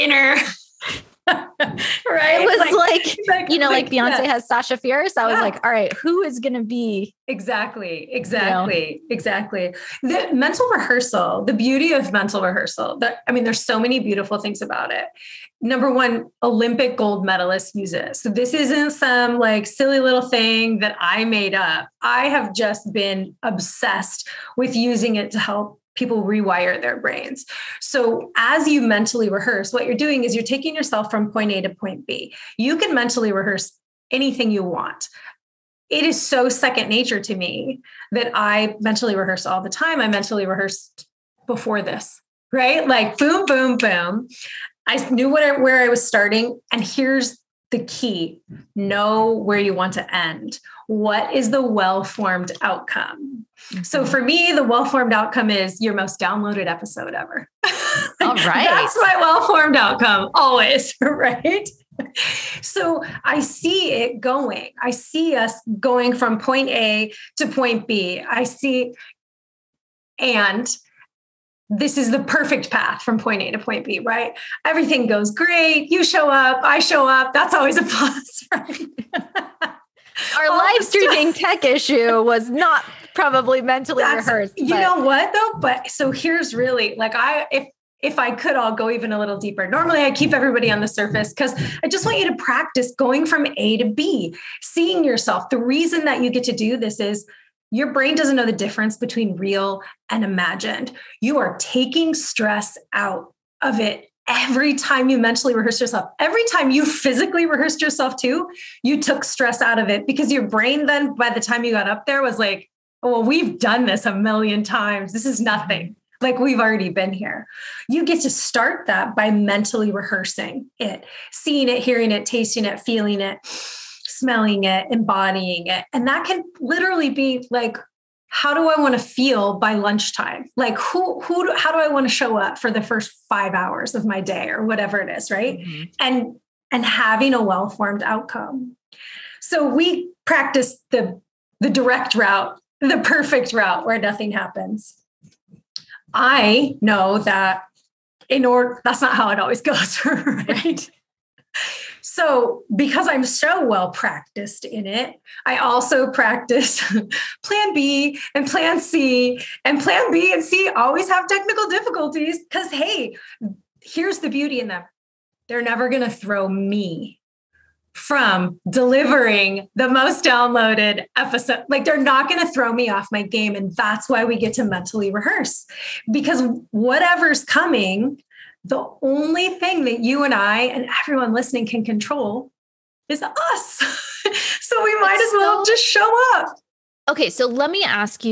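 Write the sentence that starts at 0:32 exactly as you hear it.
You can mentally rehearse anything you want.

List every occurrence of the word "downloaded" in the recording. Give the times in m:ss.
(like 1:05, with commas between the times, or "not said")
0:56, 2:50.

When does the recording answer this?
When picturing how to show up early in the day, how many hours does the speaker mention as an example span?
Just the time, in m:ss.
2:13.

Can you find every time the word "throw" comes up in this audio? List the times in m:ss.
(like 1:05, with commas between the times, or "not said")
2:46, 2:52.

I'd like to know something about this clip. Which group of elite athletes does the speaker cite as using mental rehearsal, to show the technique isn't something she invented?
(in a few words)
Olympic gold medalists.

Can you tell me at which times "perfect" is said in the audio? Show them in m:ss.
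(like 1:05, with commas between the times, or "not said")
1:12, 2:23.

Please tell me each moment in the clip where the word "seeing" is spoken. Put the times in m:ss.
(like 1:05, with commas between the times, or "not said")
1:34, 2:01.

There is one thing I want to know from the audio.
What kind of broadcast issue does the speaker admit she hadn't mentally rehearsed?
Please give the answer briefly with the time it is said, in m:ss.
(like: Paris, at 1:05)
live streaming tech issue, at 1:20.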